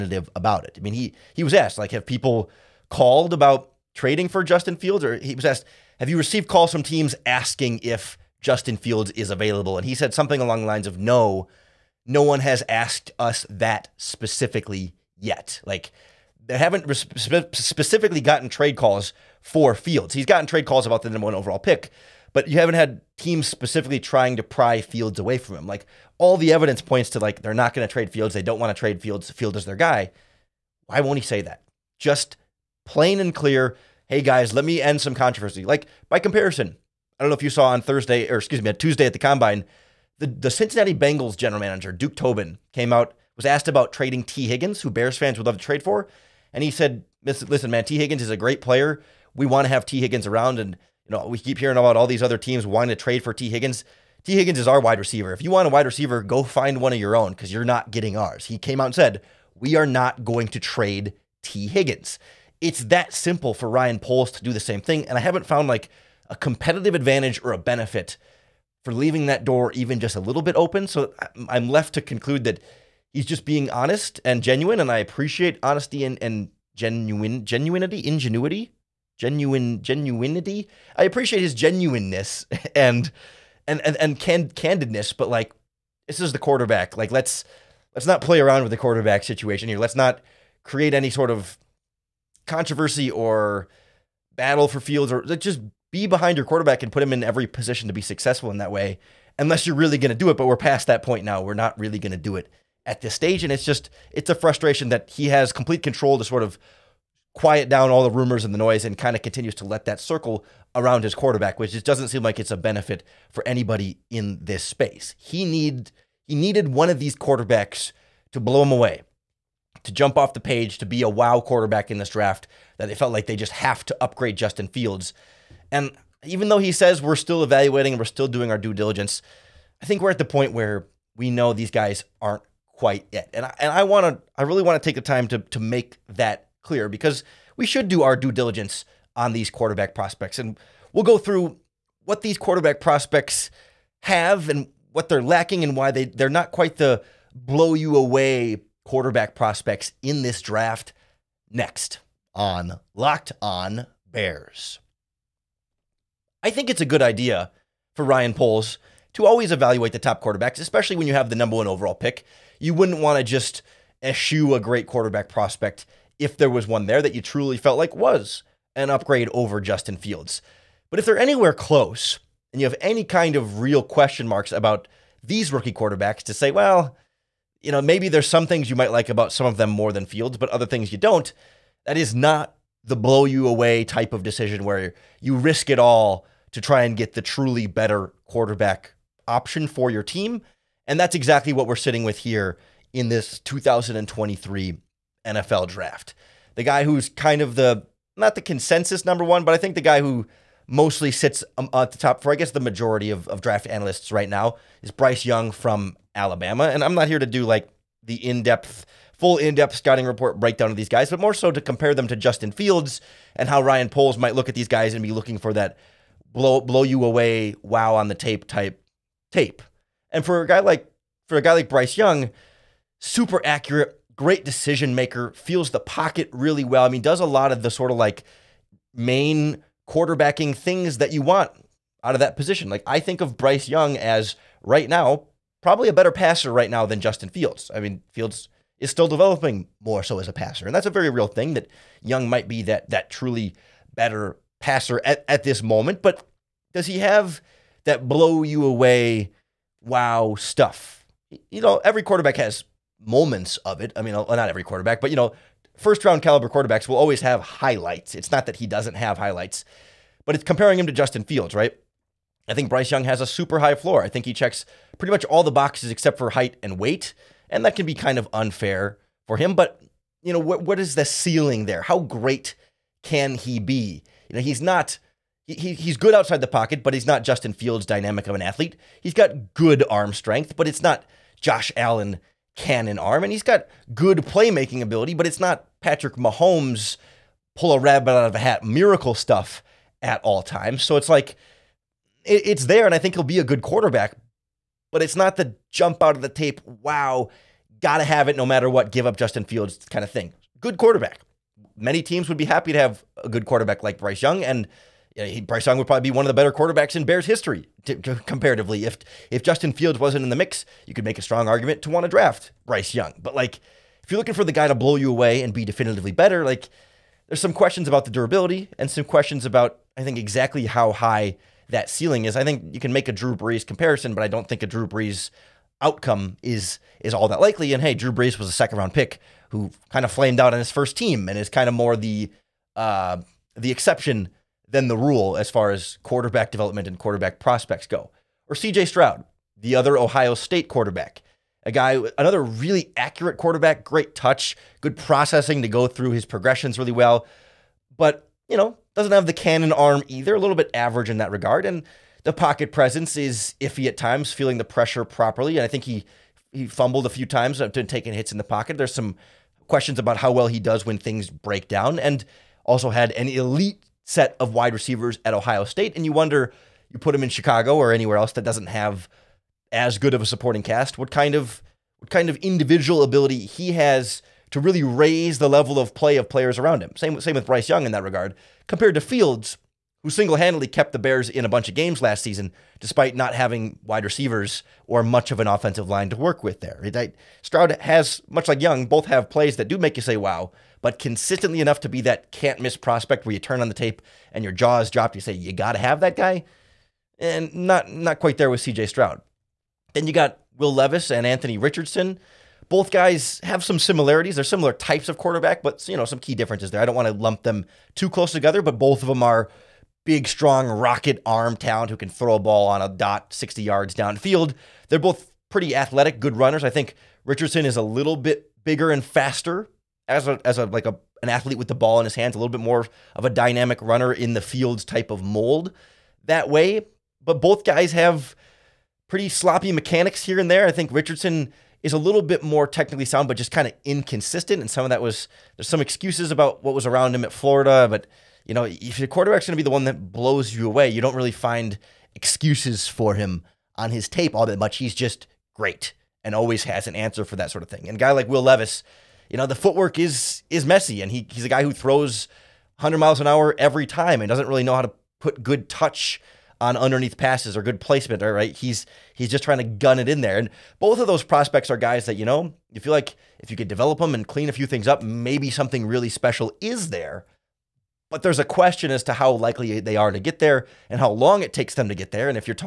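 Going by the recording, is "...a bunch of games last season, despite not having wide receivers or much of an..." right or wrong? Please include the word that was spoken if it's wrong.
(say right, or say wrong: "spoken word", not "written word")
right.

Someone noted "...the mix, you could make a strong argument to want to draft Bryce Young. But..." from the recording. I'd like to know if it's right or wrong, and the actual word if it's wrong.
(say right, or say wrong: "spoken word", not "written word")
right.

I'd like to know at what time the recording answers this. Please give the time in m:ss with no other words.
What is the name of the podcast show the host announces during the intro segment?
2:32.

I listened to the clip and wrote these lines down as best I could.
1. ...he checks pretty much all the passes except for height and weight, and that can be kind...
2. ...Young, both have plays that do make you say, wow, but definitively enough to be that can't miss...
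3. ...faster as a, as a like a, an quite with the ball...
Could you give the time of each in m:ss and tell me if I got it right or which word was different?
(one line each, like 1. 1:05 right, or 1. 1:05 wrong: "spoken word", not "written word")
1. 4:24 wrong: "boxes", not "passes"
2. 6:28 wrong: "consistently", not "definitively"
3. 6:59 wrong: "athlete", not "quite".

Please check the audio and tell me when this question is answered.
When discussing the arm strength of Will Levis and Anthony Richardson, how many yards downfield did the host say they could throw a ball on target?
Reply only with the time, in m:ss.
6:53.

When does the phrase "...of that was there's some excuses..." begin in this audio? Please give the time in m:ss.
7:14.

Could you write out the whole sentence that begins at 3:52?
Like I think of Bryce Young as right now probably a better passer right now than Justin Fields.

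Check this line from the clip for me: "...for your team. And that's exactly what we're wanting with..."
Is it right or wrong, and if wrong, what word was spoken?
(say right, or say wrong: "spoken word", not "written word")
wrong: "sitting", not "wanting".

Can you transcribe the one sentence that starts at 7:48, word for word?
But there's a question as to how likely they are to get there and how long it takes them to get there.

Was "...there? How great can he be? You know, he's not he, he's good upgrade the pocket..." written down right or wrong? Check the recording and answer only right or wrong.
wrong.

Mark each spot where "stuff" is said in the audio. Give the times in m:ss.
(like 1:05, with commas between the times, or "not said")
4:10, 4:49.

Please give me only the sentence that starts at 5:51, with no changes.
And the pocket presence is iffy at times, feeling the pressure properly.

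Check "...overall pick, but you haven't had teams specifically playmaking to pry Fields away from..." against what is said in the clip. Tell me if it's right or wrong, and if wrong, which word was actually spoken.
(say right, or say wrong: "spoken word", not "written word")
wrong: "trying", not "playmaking".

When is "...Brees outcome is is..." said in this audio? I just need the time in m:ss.
5:24.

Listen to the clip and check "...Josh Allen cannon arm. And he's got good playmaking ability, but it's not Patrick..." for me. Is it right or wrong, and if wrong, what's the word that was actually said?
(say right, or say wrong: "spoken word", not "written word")
right.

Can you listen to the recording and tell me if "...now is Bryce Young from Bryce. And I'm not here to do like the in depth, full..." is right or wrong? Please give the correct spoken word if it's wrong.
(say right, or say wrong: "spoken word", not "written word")
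wrong: "Alabama", not "Bryce".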